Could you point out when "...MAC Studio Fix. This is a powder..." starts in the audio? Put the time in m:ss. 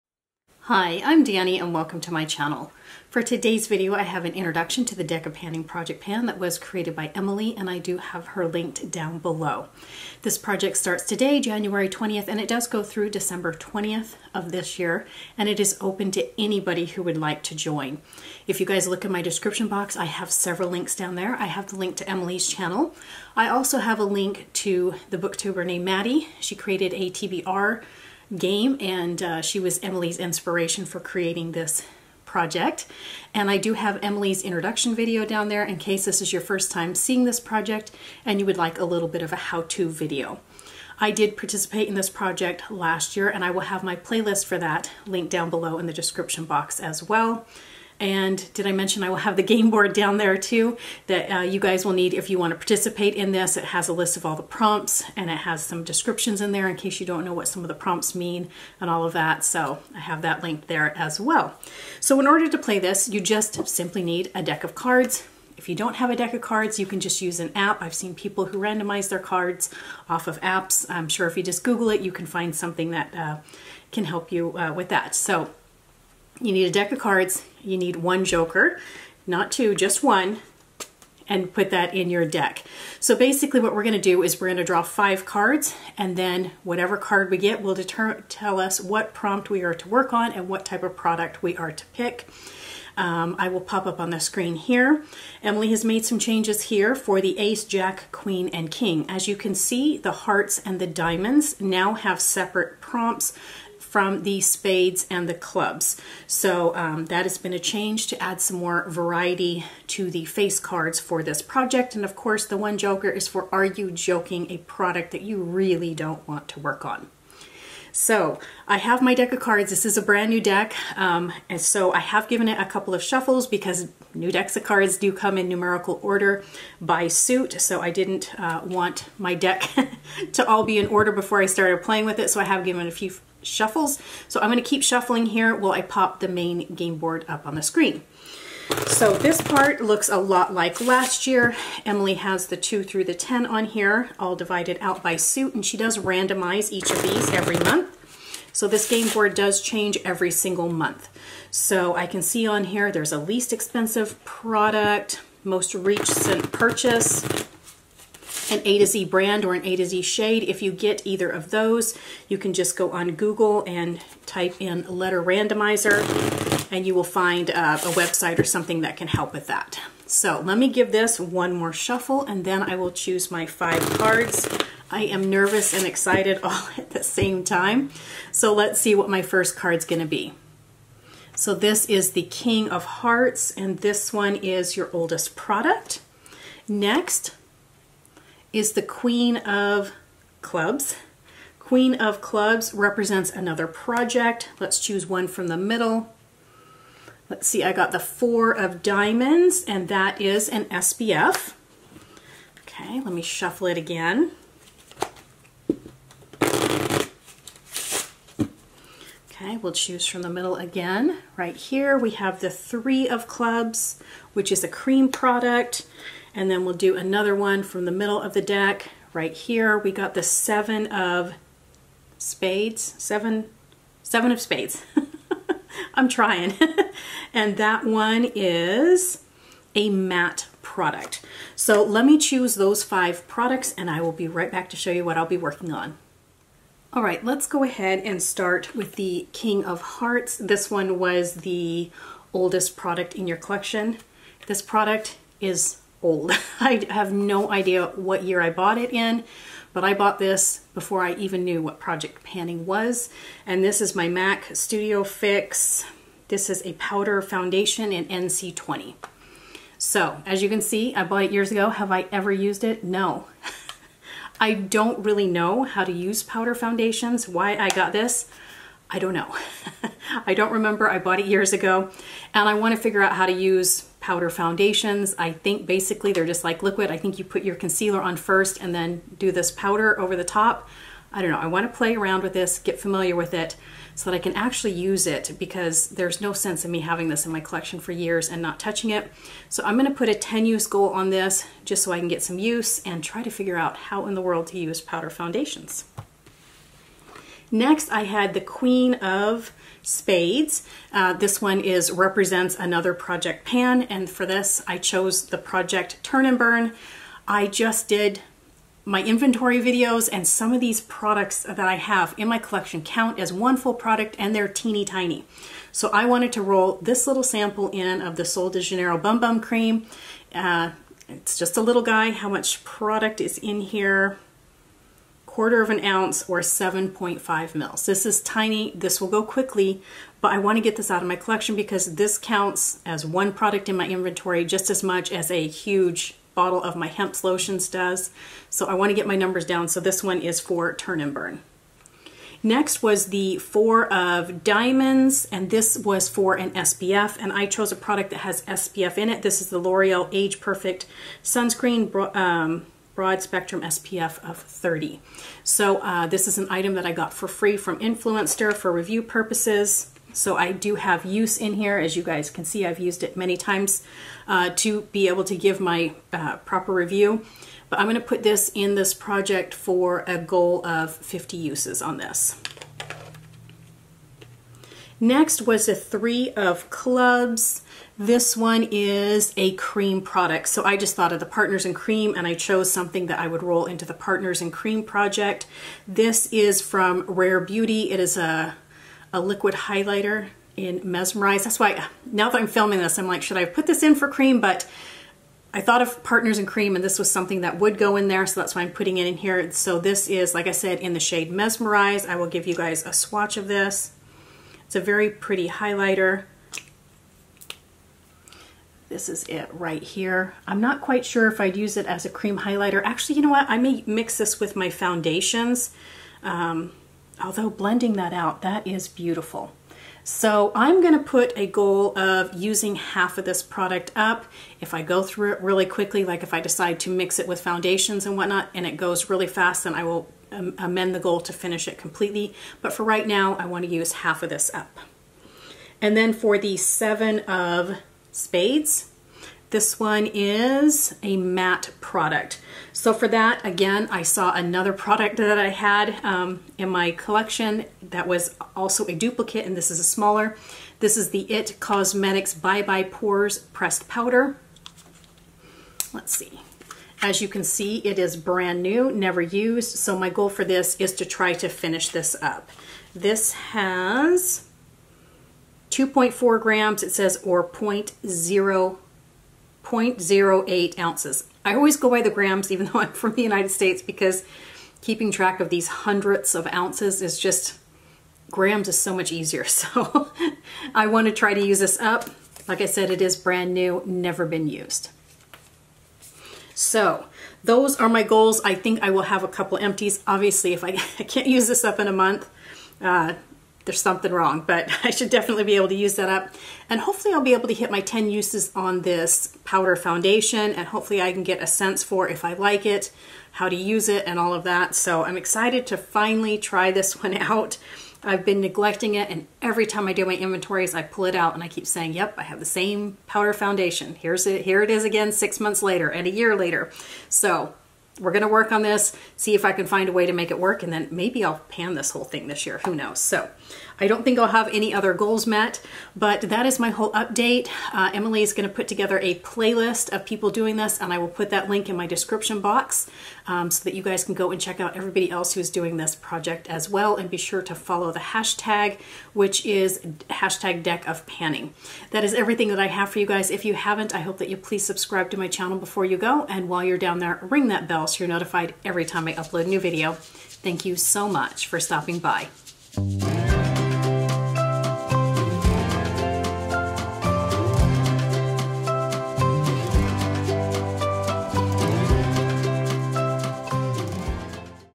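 4:14.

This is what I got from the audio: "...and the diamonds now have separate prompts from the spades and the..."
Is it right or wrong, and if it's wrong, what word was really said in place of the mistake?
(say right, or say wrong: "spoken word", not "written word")
right.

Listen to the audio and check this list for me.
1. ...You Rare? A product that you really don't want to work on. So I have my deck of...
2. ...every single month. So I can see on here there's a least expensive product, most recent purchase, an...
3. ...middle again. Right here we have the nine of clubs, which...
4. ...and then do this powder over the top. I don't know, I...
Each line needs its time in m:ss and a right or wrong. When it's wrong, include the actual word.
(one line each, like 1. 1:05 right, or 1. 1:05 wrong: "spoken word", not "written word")
1. 1:53 wrong: "Joking", not "Rare"
2. 2:30 right
3. 3:30 wrong: "three", not "nine"
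4. 4:38 right.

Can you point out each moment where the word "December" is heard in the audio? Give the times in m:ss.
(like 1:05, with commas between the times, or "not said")
0:13.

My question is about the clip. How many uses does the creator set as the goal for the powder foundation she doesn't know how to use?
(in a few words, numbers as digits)
10.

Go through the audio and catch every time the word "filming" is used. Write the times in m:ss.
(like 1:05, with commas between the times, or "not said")
6:32.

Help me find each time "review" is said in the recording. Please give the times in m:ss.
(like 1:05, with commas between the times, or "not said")
5:58, 6:06.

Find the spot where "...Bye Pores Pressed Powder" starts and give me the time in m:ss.
7:32.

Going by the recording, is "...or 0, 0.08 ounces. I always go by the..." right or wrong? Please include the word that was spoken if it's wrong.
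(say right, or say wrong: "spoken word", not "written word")
right.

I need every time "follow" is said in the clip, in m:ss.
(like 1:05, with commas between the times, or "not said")
8:57.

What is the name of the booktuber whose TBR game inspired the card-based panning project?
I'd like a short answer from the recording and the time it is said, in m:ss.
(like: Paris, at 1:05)
Maddi, at 0:25.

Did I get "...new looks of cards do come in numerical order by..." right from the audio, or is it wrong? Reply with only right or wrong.
wrong.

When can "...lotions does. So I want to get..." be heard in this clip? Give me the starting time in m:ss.
5:37.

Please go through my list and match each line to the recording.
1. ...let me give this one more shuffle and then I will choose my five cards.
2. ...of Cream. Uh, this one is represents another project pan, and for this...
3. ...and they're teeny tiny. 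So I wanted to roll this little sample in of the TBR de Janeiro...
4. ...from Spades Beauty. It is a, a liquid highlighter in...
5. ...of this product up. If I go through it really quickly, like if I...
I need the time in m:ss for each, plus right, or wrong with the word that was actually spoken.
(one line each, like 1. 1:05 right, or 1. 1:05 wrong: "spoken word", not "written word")
1. 2:50 right
2. 4:58 wrong: "Spades", not "Cream"
3. 5:14 wrong: "Sol", not "TBR"
4. 6:26 wrong: "Rare", not "Spades"
5. 7:03 right.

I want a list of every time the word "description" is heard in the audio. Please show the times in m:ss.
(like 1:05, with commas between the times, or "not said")
0:19, 0:45, 0:55, 8:51.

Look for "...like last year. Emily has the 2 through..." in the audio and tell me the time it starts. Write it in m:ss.
2:20.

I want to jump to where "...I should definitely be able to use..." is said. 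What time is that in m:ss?
8:14.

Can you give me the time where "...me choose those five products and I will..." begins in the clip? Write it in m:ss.
3:52.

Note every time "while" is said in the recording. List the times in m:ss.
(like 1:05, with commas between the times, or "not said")
2:15, 9:06.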